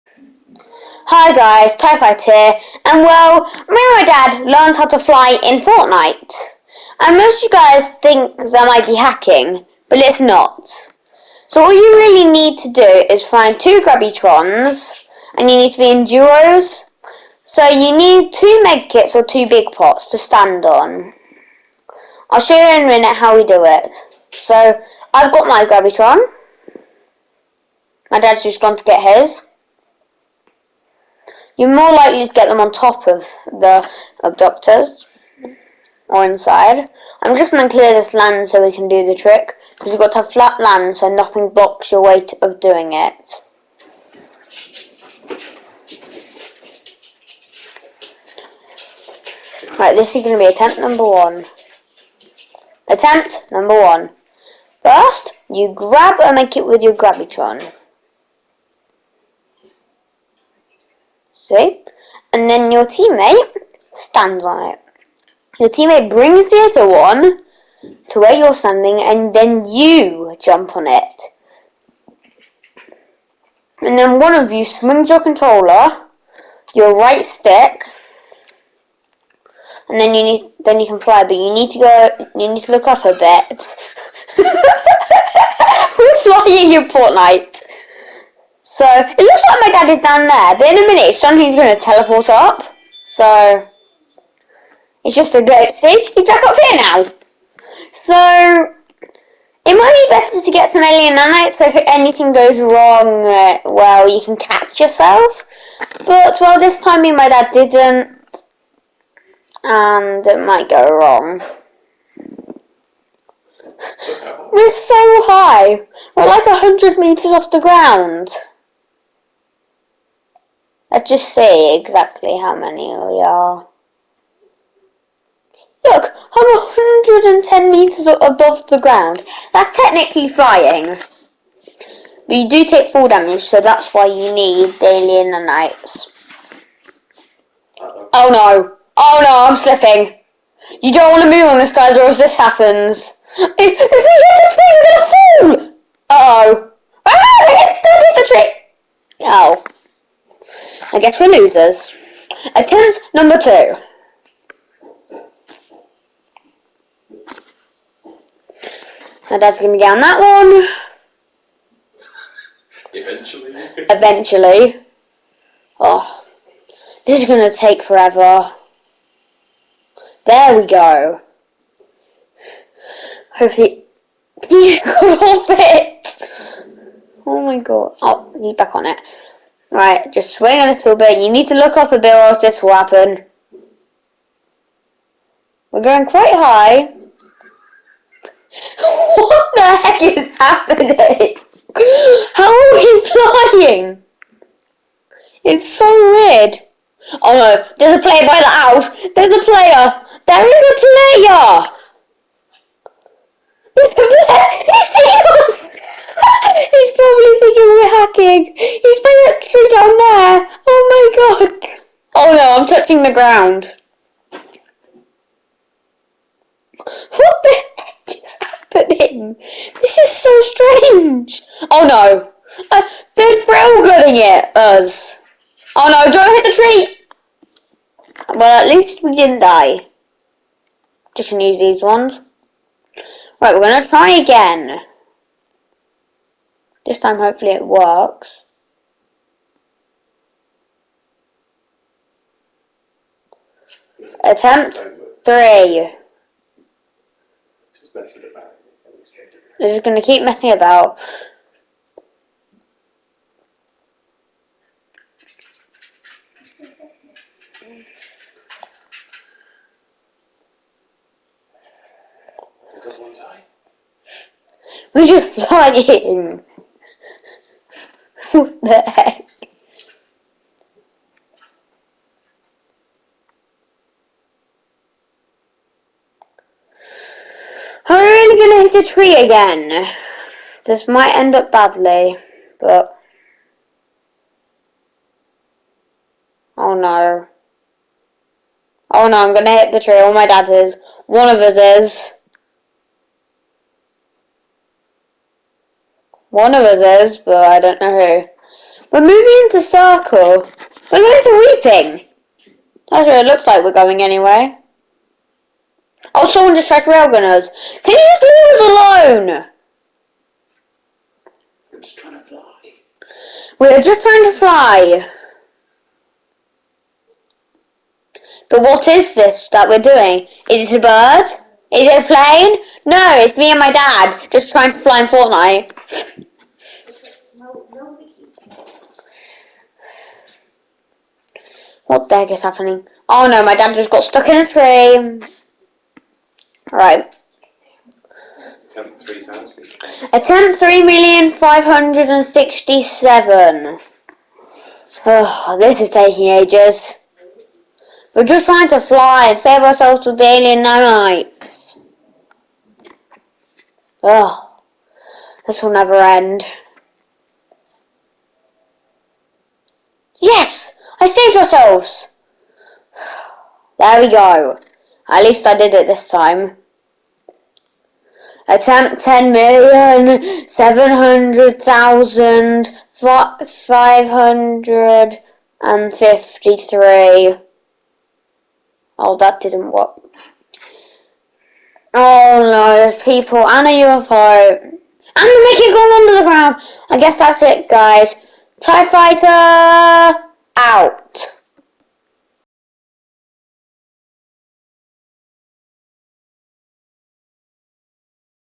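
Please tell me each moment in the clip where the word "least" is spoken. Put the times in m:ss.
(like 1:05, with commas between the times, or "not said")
3:48, 6:05.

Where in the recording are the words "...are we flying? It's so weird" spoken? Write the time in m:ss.
3:12.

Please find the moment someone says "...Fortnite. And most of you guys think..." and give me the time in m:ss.
0:05.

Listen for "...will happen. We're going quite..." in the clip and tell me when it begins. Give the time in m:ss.
3:02.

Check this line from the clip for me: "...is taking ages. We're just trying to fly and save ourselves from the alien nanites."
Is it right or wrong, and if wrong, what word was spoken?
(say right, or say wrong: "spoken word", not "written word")
right.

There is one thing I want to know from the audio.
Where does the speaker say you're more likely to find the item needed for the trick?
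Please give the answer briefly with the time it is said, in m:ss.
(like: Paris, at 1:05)
On top of the abductors, at 0:32.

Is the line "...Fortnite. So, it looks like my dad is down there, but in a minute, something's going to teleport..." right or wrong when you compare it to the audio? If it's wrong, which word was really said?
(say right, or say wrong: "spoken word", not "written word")
right.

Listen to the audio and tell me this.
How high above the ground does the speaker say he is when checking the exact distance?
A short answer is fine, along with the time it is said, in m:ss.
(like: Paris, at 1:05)
110 metres, at 2:06.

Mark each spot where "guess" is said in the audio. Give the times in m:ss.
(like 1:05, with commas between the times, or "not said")
2:30, 6:26.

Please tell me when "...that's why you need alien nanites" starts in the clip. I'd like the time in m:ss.
2:13.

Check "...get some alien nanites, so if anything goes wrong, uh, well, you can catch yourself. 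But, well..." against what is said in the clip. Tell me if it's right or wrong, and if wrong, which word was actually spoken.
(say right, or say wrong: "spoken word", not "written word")
right.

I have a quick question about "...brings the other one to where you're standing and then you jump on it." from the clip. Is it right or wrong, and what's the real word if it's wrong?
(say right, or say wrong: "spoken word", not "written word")
right.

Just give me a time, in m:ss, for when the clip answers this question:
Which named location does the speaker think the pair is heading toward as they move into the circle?
5:01.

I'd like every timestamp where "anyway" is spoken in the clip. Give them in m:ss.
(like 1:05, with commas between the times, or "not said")
5:04.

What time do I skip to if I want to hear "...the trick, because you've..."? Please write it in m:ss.
0:39.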